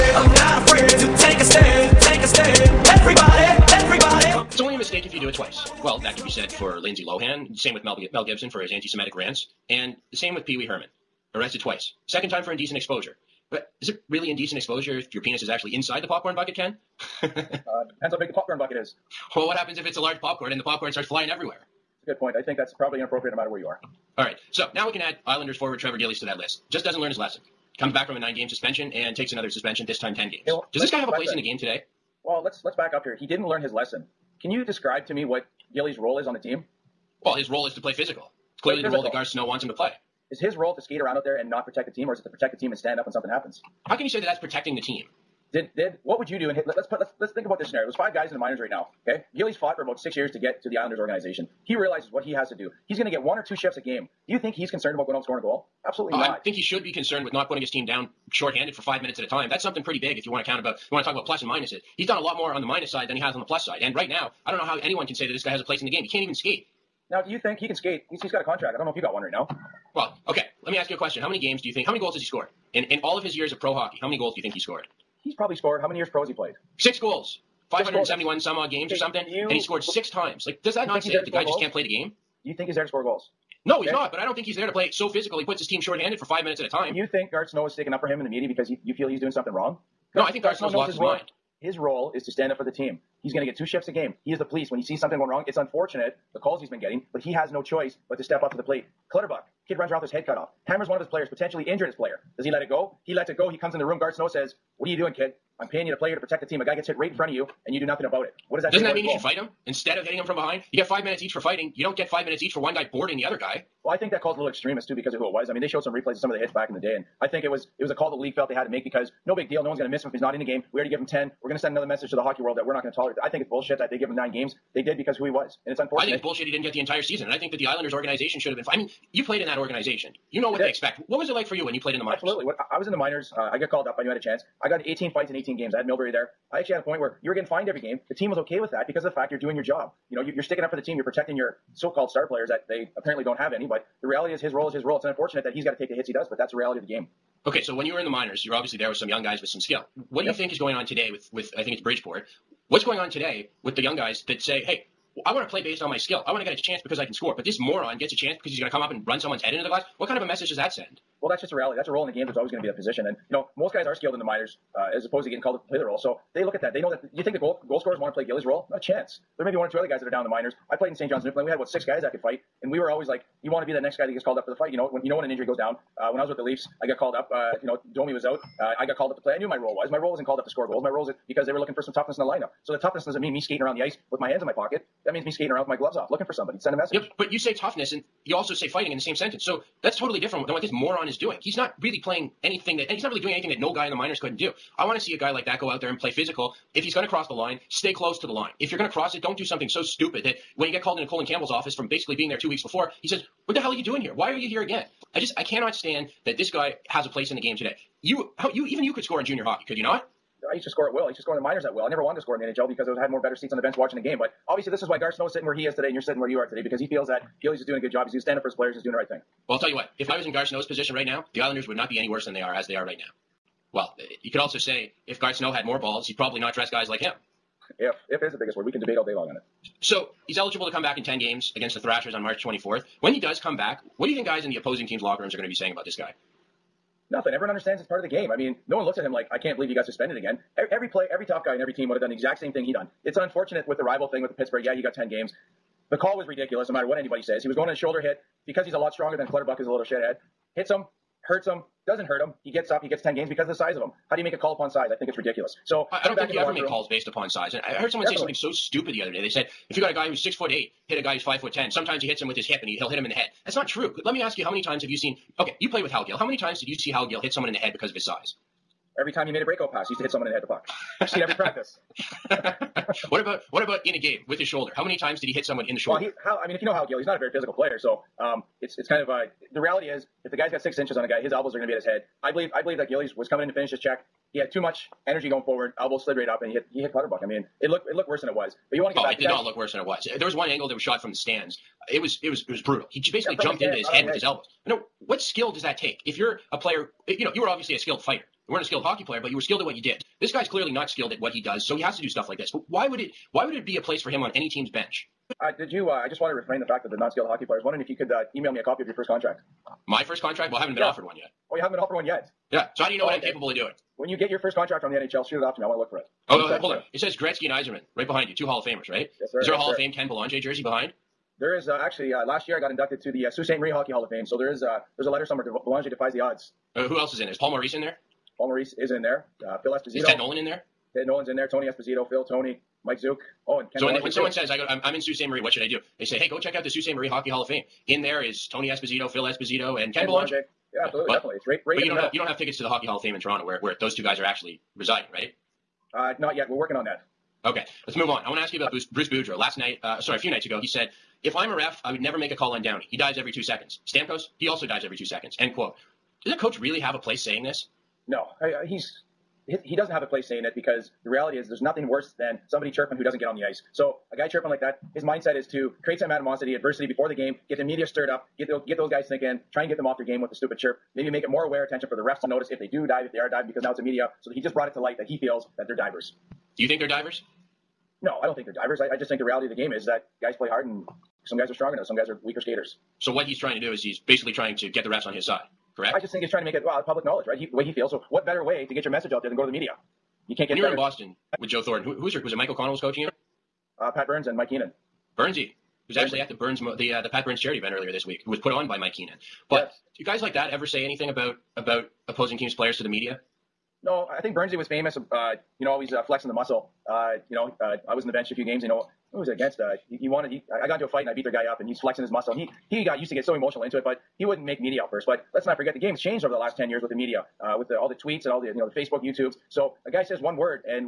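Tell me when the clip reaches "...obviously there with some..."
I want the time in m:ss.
2:28.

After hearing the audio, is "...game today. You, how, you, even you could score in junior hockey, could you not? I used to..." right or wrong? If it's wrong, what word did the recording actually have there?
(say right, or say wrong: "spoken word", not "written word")
right.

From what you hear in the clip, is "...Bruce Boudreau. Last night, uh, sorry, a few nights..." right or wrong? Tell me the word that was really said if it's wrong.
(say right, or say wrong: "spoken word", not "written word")
right.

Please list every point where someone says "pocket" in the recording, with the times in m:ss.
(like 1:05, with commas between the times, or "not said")
3:04.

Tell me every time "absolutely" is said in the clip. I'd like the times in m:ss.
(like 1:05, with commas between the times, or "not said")
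0:55, 2:12, 5:40.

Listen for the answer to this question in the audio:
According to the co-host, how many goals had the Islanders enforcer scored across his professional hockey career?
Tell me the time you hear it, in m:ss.
1:16.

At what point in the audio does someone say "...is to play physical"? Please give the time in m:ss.
0:37.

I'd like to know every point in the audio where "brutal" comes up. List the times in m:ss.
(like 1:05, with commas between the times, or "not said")
4:52.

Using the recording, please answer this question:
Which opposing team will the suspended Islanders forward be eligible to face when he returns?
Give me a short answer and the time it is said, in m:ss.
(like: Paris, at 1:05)
Thrashers, at 3:51.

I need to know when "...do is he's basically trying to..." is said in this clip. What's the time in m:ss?
6:23.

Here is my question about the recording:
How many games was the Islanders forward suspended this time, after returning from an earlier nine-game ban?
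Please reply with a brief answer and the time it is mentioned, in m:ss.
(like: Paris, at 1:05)
10, at 0:29.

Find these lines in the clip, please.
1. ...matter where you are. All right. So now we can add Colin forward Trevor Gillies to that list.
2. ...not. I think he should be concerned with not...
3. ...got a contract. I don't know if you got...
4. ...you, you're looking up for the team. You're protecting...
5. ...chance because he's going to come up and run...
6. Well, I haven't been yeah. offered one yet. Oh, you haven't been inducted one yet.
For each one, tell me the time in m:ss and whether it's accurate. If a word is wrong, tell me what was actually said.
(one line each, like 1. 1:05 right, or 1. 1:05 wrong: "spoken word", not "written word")
1. 0:23 wrong: "Islanders", not "Colin"
2. 0:56 right
3. 1:08 right
4. 2:20 wrong: "sticking", not "looking"
5. 2:38 right
6. 5:10 wrong: "offered", not "inducted".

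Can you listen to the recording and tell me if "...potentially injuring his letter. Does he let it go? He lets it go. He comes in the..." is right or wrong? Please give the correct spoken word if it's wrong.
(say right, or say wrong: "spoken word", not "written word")
wrong: "player", not "letter".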